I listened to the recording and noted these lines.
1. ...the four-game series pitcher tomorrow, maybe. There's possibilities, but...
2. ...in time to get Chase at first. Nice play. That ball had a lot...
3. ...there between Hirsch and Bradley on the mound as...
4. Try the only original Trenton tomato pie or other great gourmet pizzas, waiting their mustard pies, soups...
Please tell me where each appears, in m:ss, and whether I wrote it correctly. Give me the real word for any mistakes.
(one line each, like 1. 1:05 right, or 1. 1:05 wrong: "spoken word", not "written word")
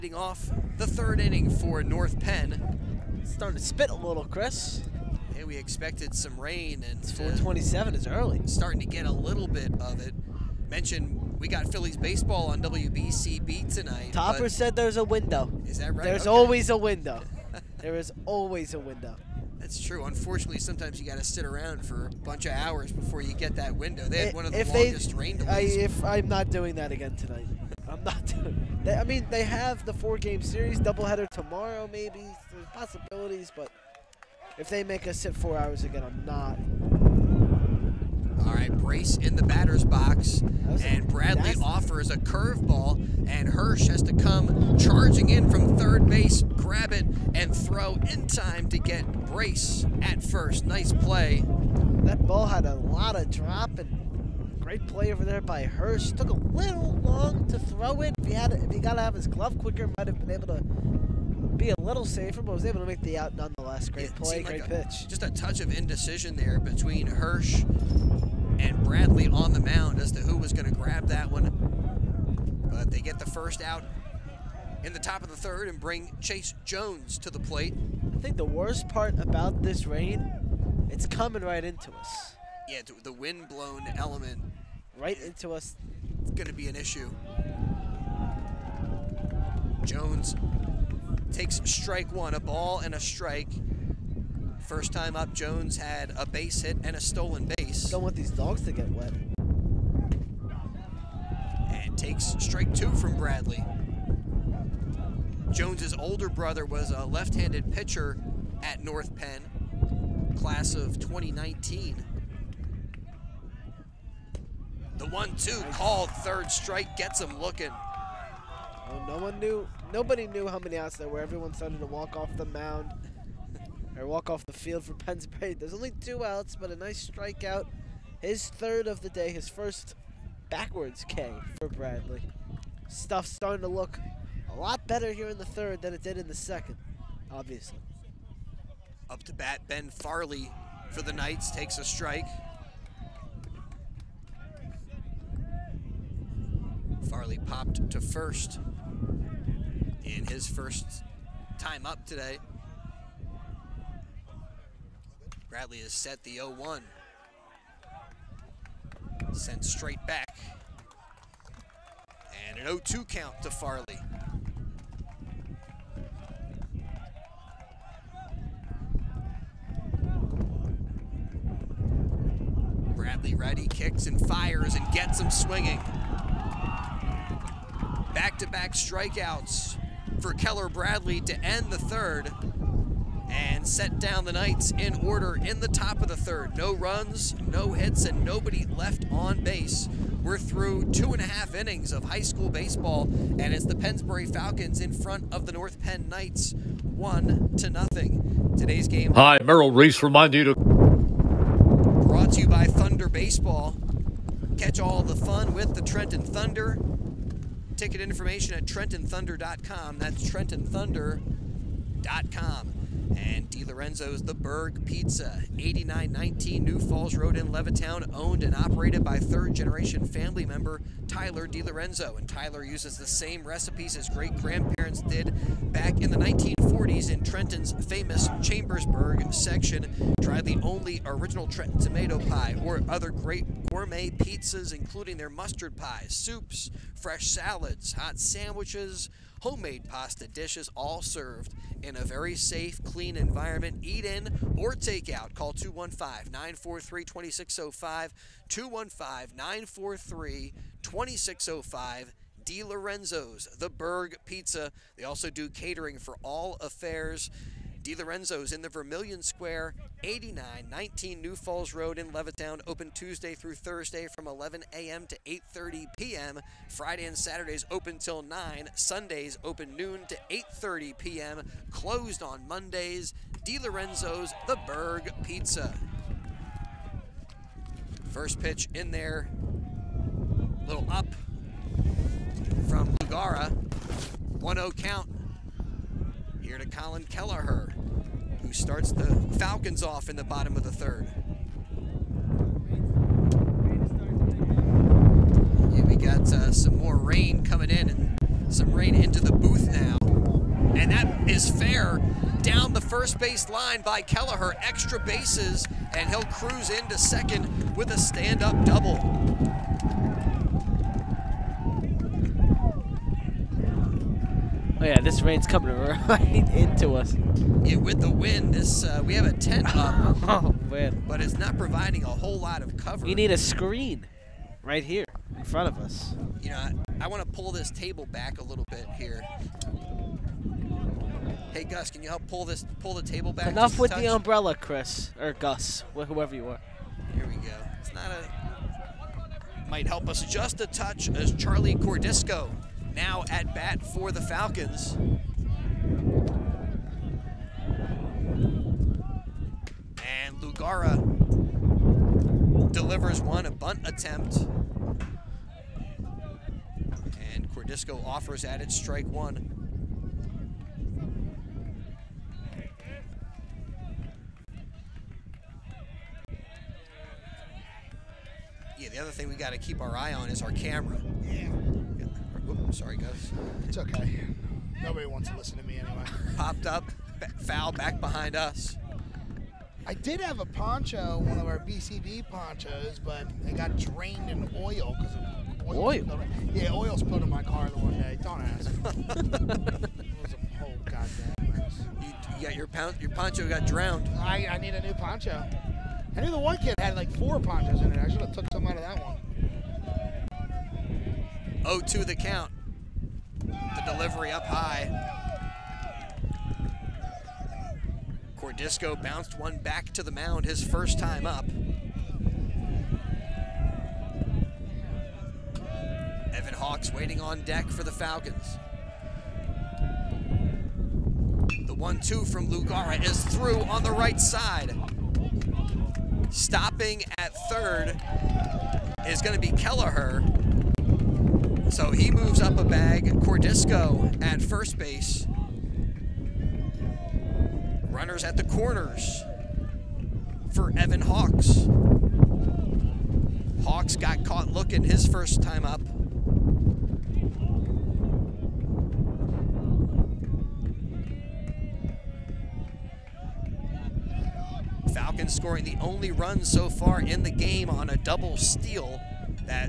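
1. 0:29 wrong: "doubleheader", not "pitcher"
2. 0:48 wrong: "Brace", not "Chase"
3. 1:06 right
4. 3:50 wrong: "including", not "waiting".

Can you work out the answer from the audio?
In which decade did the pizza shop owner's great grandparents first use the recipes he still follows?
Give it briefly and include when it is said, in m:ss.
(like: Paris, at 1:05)
1940s, at 3:46.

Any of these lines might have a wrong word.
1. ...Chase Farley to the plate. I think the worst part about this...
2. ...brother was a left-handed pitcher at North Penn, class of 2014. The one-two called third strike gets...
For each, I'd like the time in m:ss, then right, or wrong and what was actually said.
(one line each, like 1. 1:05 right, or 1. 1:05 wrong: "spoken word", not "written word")
1. 1:16 wrong: "Jones", not "Farley"
2. 1:46 wrong: "2019", not "2014".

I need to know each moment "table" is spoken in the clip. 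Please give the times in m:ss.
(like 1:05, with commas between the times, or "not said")
5:27, 5:33.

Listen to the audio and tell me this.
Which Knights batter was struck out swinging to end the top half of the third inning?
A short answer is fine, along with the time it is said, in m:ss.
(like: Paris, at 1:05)
Ben Farley, at 2:19.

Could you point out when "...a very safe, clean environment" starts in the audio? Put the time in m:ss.
4:01.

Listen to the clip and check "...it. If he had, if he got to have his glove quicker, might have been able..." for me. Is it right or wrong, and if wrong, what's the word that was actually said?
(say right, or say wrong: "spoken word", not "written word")
right.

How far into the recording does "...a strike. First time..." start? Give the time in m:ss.
1:32.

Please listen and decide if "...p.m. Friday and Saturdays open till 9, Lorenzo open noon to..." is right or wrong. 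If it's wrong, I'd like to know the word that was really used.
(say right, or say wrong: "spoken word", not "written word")
wrong: "Sundays", not "Lorenzo".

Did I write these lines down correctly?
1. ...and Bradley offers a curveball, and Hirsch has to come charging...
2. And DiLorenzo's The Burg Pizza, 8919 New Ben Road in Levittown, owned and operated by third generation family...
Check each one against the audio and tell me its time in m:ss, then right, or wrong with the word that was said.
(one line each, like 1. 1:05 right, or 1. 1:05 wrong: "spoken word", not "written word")
1. 0:40 right
2. 3:33 wrong: "Falls", not "Ben".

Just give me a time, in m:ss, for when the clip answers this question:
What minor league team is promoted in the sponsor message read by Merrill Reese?
3:25.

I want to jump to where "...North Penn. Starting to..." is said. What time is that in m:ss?
0:01.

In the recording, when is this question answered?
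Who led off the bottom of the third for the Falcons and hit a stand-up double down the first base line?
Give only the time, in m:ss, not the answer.
4:46.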